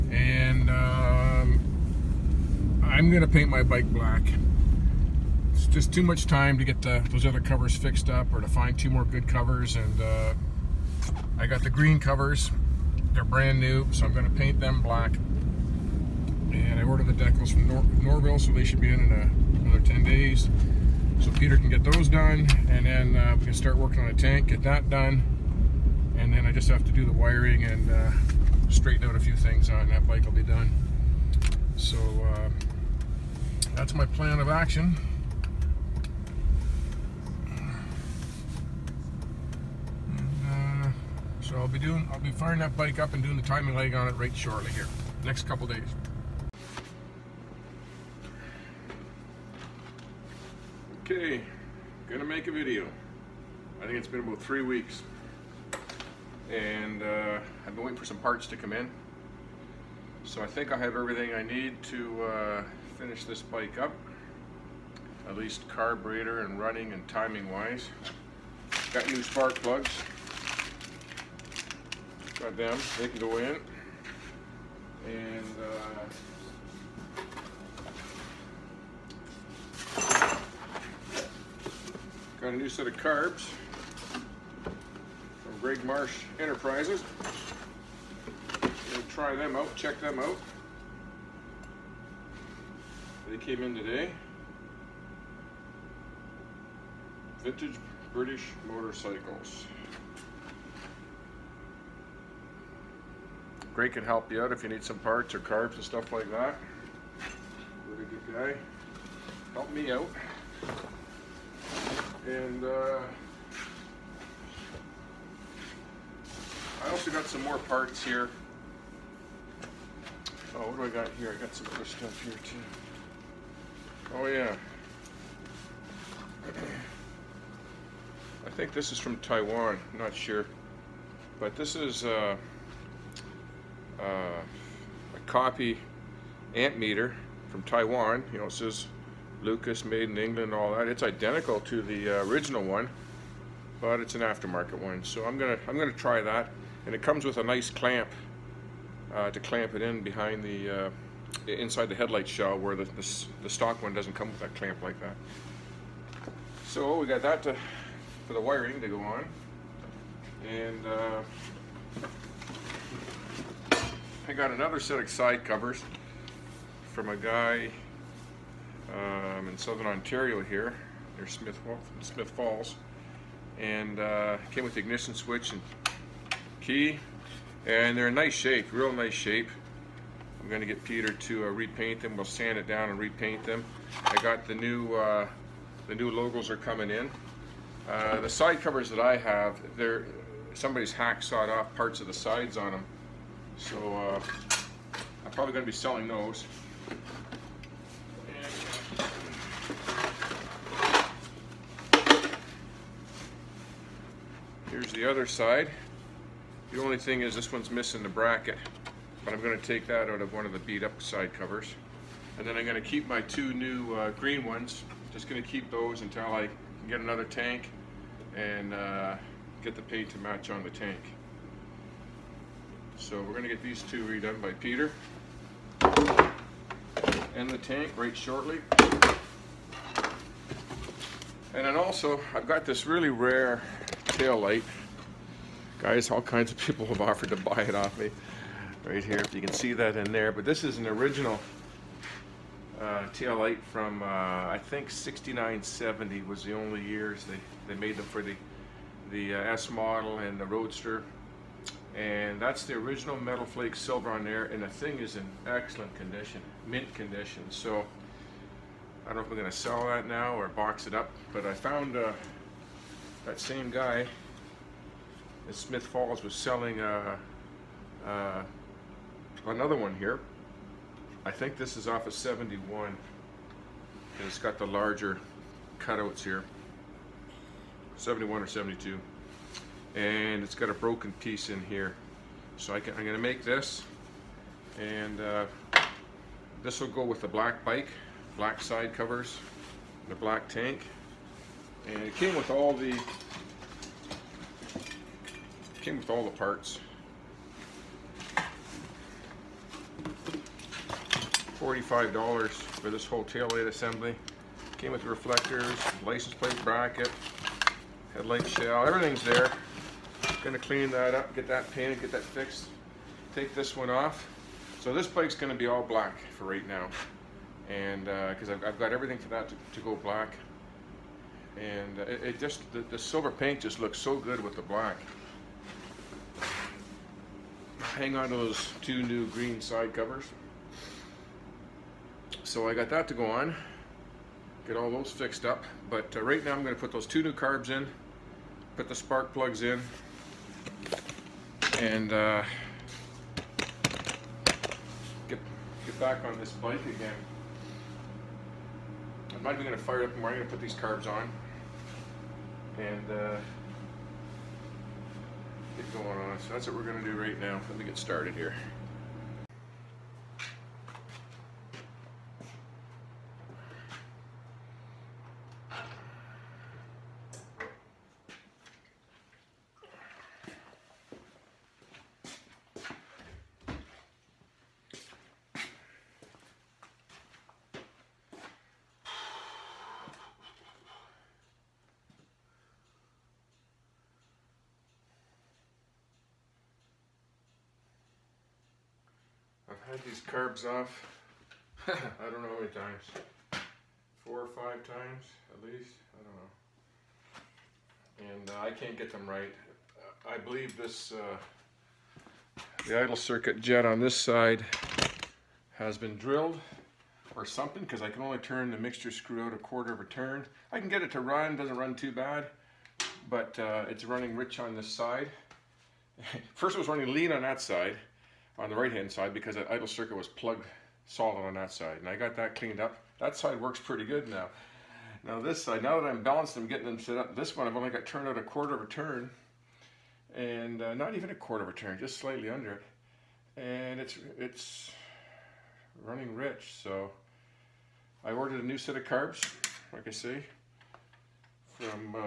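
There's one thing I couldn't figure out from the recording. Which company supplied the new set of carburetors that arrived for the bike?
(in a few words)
Greg Marsh Enterprises.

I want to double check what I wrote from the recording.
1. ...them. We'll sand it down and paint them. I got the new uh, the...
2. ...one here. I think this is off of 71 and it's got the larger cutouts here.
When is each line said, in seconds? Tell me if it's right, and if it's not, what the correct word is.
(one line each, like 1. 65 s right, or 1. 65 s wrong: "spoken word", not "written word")
1. 182 s wrong: "repaint", not "paint"
2. 269 s right.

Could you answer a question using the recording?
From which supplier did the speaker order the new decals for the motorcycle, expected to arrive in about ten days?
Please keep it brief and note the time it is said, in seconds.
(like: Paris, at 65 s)
Norvil, at 17 s.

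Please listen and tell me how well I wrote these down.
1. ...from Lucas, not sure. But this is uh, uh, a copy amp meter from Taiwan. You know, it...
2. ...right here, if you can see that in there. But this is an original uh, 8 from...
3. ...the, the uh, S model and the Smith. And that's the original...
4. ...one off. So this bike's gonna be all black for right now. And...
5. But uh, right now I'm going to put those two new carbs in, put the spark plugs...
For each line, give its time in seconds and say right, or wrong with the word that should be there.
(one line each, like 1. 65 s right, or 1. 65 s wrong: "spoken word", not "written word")
1. 128 s wrong: "Taiwan", not "Lucas"
2. 238 s right
3. 248 s wrong: "Roadster", not "Smith"
4. 313 s right
5. 335 s right.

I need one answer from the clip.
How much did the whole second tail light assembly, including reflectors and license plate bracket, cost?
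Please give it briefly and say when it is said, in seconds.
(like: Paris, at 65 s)
$45, at 301 s.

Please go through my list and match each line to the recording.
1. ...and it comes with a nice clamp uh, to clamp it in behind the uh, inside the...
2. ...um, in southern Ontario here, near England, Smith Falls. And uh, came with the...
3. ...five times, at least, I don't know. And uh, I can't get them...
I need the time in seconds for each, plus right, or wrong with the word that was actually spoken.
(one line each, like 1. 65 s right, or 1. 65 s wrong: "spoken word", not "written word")
1. 146 s right
2. 168 s wrong: "Smith", not "England"
3. 394 s right.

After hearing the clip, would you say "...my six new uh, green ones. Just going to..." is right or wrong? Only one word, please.
wrong.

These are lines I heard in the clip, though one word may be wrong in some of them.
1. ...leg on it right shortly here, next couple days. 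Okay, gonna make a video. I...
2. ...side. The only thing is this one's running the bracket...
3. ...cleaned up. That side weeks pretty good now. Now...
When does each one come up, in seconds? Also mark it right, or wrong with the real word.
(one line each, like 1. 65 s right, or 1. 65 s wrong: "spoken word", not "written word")
1. 43 s right
2. 205 s wrong: "missing", not "running"
3. 422 s wrong: "works", not "weeks".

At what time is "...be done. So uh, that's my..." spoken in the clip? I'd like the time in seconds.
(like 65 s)
30 s.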